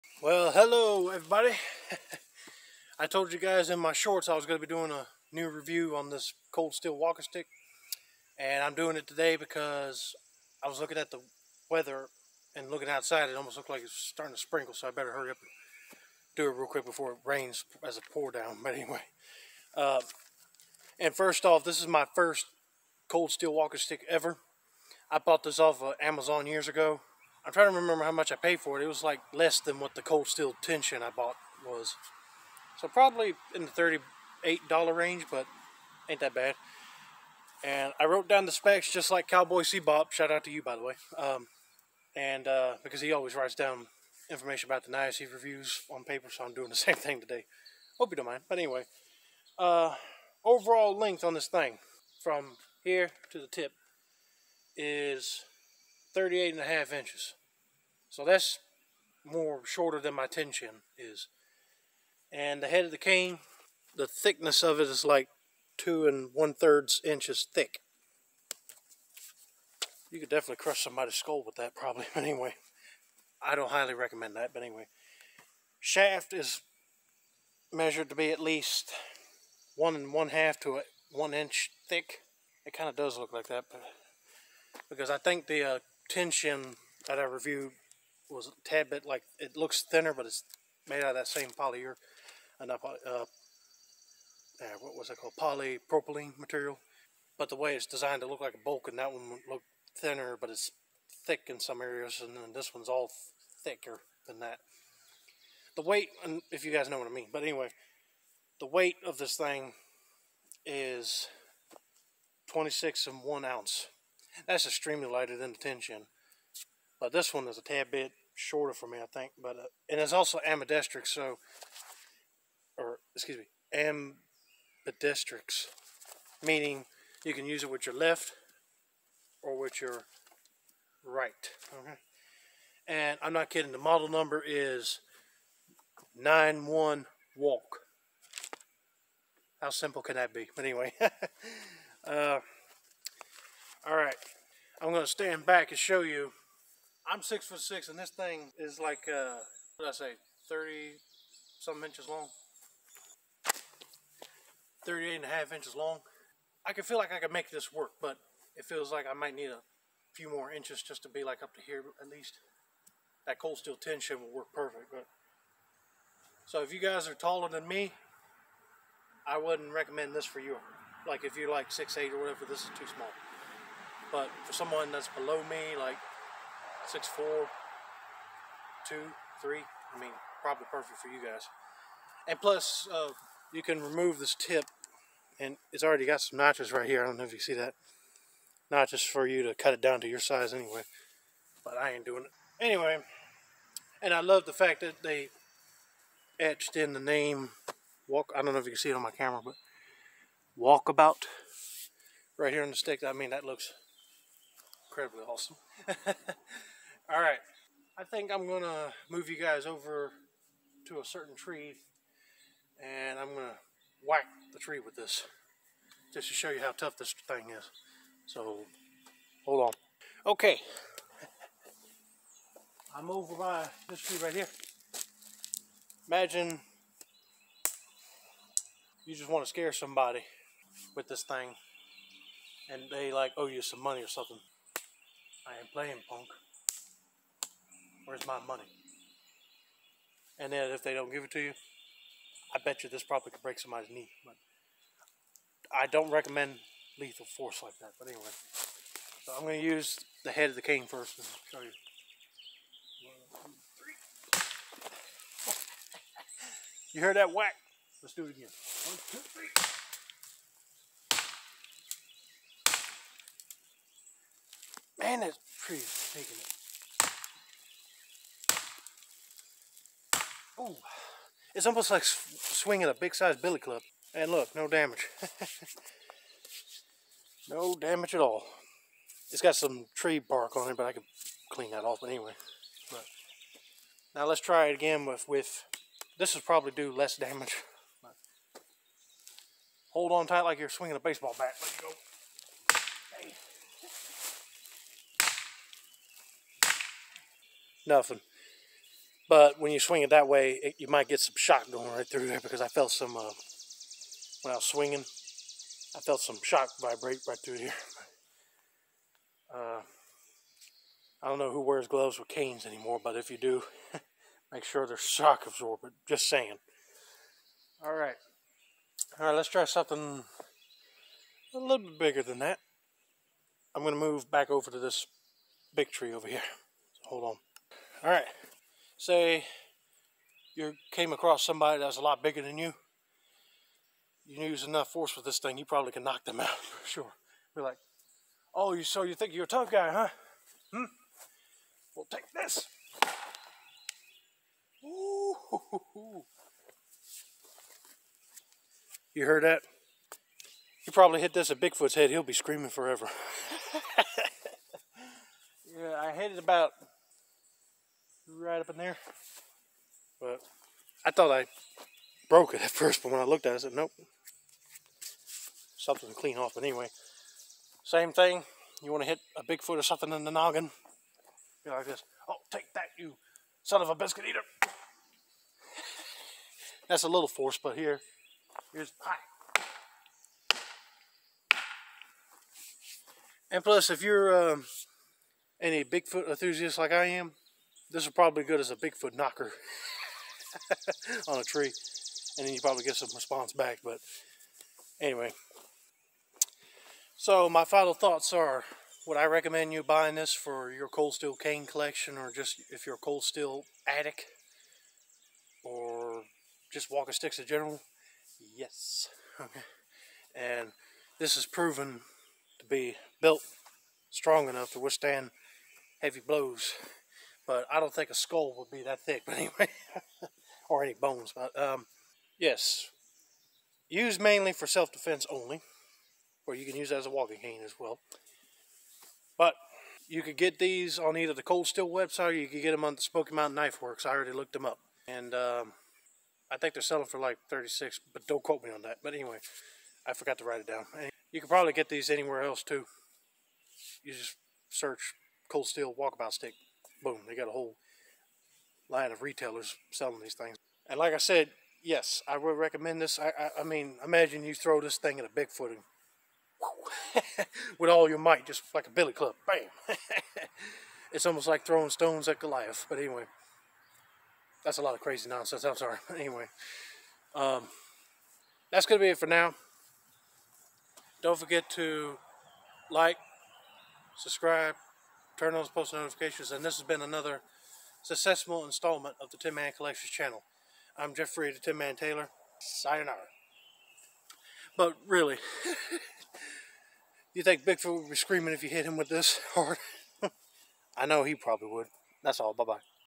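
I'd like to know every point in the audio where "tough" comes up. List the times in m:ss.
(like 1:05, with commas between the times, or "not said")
3:36, 5:39.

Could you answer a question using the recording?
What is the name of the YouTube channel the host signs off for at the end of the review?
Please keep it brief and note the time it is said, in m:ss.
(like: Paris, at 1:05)
Tin Man Collections, at 7:59.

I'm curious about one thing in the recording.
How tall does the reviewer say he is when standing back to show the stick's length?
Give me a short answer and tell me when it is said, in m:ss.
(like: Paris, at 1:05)
6 foot 6, at 2:27.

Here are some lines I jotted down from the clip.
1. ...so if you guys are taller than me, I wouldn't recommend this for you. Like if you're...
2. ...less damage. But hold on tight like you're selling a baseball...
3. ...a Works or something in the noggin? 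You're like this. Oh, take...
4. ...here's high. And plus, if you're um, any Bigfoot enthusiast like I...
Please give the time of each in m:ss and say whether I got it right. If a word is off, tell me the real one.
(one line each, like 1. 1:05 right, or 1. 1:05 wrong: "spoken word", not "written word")
1. 2:46 right
2. 4:46 wrong: "swinging", not "selling"
3. 6:09 wrong: "Bigfoot", not "Works"
4. 6:18 right.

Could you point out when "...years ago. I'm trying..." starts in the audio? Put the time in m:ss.
0:26.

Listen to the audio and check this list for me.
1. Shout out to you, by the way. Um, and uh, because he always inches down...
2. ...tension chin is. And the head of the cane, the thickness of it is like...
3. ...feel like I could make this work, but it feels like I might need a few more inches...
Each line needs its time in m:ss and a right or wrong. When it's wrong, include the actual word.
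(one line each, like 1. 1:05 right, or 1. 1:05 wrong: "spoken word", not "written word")
1. 0:40 wrong: "writes", not "inches"
2. 1:00 right
3. 2:36 right.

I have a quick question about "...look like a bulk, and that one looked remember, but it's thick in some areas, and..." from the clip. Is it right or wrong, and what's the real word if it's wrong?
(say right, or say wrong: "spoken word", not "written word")
wrong: "thinner", not "remember".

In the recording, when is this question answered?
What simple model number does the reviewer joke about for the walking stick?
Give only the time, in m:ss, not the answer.
2:16.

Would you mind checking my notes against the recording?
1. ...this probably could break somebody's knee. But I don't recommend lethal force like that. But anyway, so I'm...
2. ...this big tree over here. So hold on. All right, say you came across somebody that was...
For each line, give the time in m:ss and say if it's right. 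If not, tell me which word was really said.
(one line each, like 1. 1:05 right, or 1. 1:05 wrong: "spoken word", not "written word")
1. 4:02 right
2. 5:24 right.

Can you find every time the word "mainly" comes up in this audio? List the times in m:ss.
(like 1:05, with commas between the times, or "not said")
7:04.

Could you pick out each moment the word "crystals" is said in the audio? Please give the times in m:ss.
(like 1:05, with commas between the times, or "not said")
not said.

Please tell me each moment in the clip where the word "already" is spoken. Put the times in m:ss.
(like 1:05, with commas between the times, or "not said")
3:05, 7:14.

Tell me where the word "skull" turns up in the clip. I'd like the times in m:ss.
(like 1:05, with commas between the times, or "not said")
1:11, 6:58.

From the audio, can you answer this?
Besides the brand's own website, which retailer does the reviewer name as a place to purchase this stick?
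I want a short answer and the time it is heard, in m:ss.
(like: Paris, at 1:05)
Smoky Mountain Knife Works, at 7:13.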